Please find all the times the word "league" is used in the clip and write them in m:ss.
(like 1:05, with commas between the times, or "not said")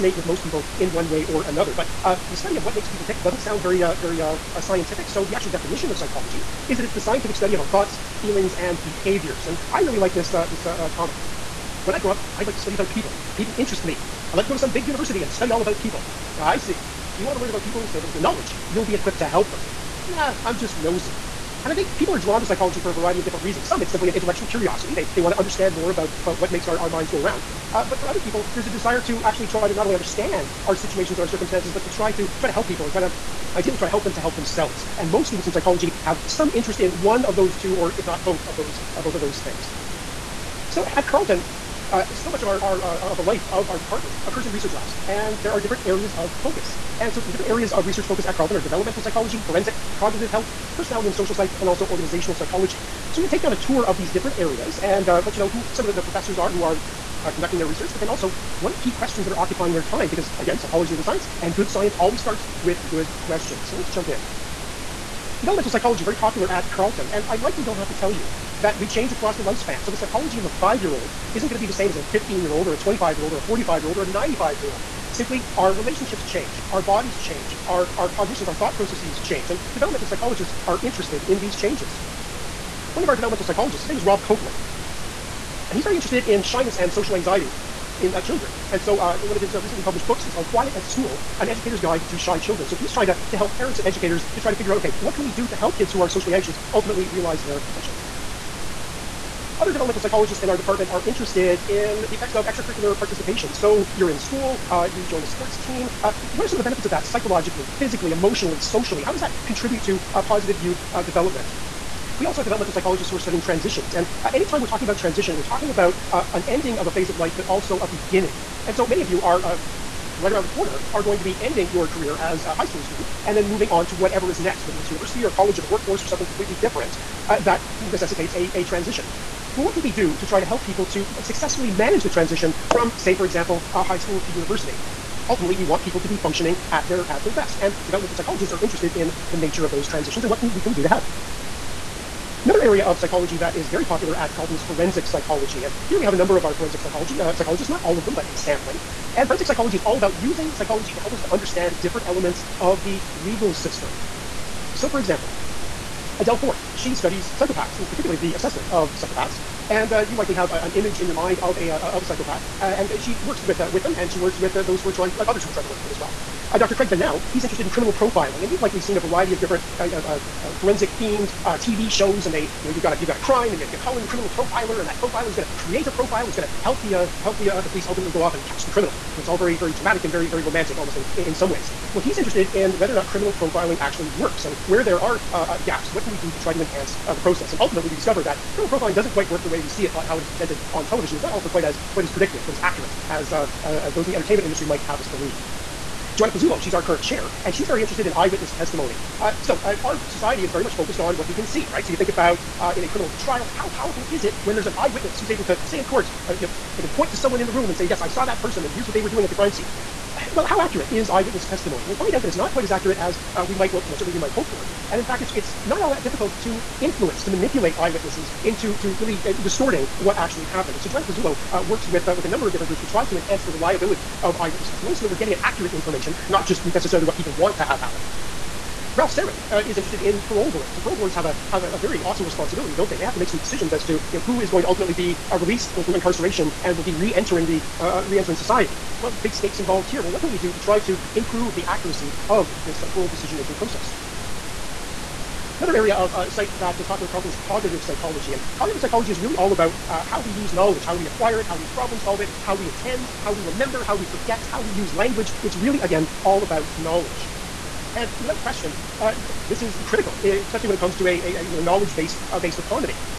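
not said.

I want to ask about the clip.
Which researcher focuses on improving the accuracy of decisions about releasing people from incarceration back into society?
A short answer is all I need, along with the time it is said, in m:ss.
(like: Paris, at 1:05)
Ralph Serin, at 3:48.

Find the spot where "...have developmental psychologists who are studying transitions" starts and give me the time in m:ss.
1:52.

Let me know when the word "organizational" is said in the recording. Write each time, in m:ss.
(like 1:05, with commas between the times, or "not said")
0:51.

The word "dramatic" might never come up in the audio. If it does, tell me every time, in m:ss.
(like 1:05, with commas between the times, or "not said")
2:59.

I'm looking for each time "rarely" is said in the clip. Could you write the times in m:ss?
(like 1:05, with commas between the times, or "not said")
not said.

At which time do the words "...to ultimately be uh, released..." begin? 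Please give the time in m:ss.
3:54.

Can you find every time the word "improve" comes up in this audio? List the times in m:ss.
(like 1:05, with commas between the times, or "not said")
4:01.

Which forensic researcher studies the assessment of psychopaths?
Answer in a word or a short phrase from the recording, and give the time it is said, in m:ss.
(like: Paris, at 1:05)
Adelle Forth, at 2:36.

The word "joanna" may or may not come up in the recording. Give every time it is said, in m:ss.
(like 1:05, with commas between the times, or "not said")
3:16, 3:40.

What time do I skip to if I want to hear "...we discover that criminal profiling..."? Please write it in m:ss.
3:07.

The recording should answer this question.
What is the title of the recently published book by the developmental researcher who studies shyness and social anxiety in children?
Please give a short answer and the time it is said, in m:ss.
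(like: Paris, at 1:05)
Quiet at School, at 1:30.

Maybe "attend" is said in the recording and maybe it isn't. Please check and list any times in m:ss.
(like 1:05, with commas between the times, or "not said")
4:12.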